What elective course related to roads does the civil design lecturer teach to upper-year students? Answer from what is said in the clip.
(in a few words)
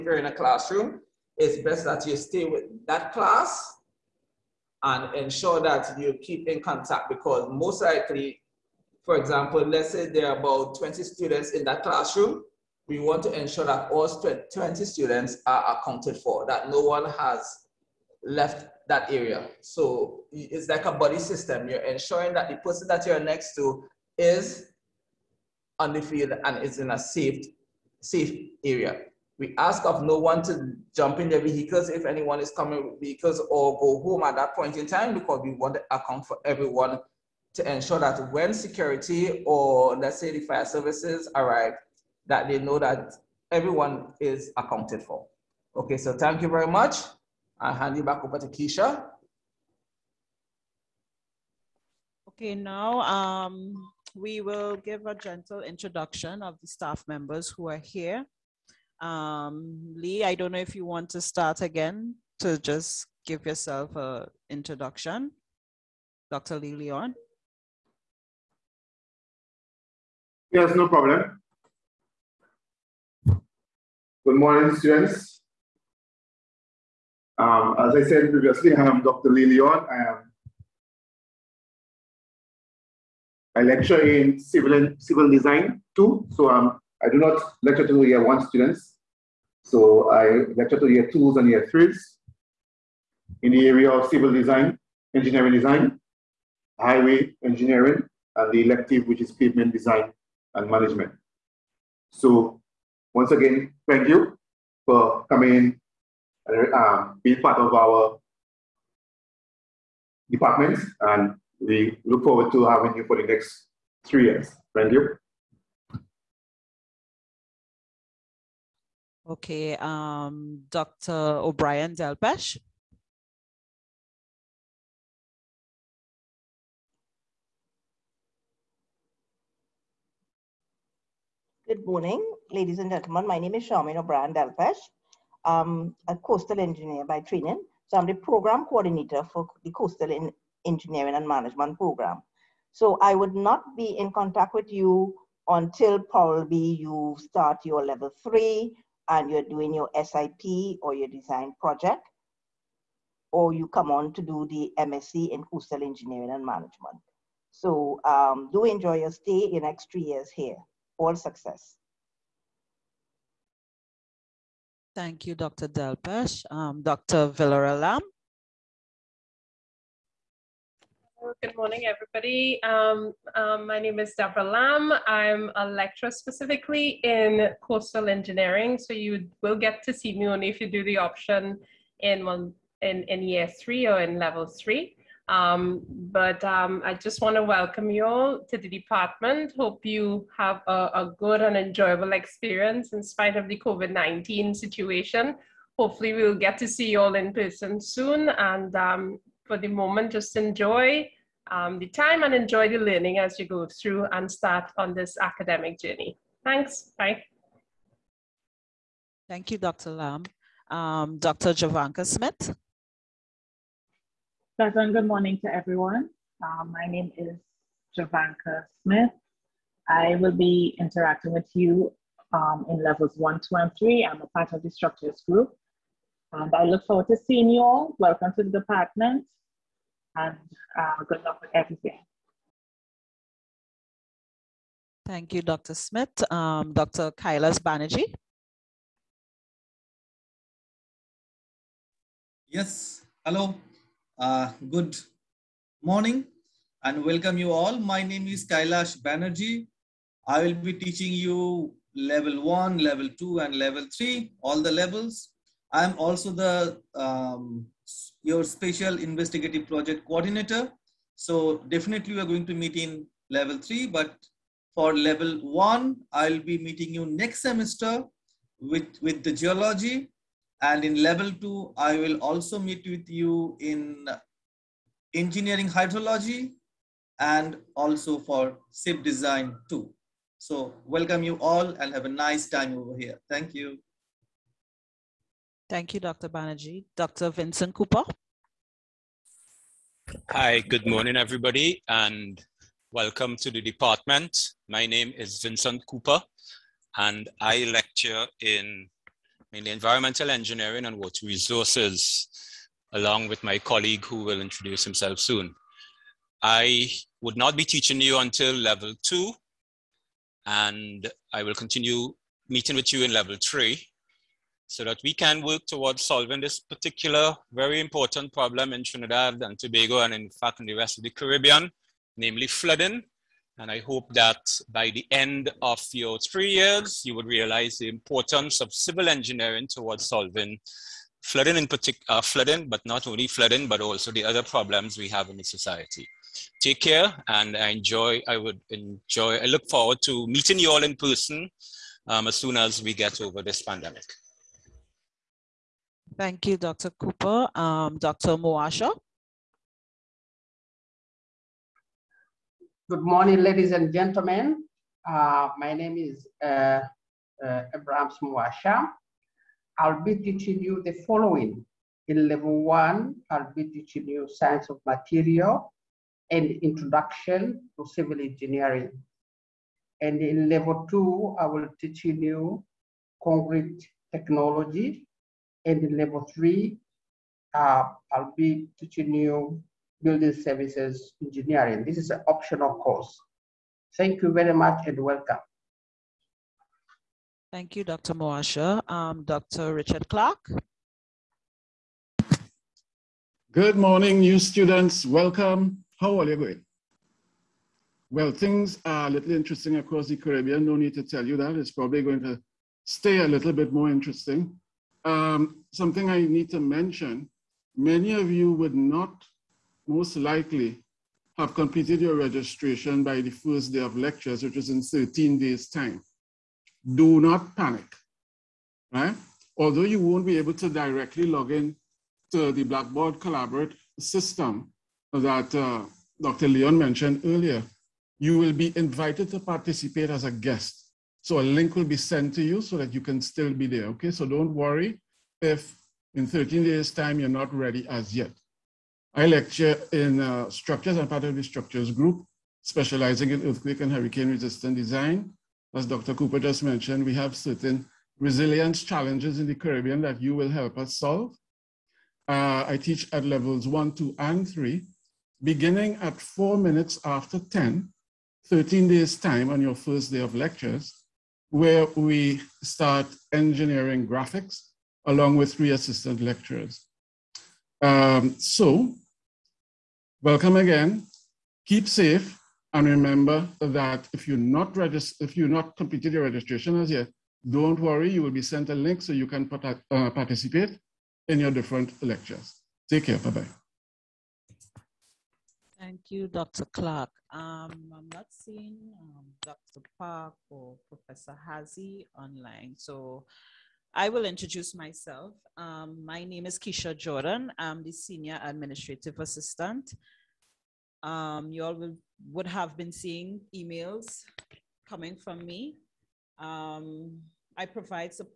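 Pavement design and management.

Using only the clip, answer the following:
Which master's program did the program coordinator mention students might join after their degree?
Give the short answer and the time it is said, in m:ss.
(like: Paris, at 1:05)
MSc in Coastal Engineering and Management, at 2:34.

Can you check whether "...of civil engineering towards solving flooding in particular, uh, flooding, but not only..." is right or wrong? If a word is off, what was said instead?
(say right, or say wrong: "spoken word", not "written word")
right.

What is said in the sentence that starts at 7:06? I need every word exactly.
Leon mentioned earlier, you will be invited to participate as a guest.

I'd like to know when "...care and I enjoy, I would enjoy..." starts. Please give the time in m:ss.
5:36.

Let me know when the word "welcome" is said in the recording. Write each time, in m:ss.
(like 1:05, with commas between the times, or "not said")
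3:07, 3:47, 4:07, 4:40, 4:52, 6:25, 6:35, 7:50.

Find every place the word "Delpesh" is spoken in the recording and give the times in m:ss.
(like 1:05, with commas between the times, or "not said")
2:01, 2:14, 2:45.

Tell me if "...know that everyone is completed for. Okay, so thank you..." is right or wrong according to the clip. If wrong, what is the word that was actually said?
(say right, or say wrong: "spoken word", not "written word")
wrong: "accounted", not "completed".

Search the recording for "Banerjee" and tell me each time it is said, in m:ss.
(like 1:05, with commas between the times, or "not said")
3:57, 4:09, 4:46.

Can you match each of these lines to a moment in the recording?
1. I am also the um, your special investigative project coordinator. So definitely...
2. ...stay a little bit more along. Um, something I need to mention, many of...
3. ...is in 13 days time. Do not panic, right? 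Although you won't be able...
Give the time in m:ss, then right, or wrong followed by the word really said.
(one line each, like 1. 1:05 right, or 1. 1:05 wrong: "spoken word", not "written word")
1. 4:15 right
2. 6:42 wrong: "interesting", not "along"
3. 6:54 right.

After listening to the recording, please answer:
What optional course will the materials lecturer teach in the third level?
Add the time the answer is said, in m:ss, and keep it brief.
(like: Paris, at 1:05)
Building services engineering, at 6:20.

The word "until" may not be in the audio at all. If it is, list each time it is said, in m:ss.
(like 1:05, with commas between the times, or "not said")
2:25, 5:08.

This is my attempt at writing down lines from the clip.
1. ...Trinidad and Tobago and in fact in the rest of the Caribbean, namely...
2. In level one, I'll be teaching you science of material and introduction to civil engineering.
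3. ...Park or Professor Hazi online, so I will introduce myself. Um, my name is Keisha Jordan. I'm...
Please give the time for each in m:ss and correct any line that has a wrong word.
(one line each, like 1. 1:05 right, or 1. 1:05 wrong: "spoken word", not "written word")
1. 5:18 right
2. 6:02 right
3. 8:09 right.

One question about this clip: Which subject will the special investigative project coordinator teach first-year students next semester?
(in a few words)
Geology.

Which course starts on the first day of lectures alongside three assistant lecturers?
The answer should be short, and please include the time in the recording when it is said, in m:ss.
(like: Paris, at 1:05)
Engineering graphics, at 7:43.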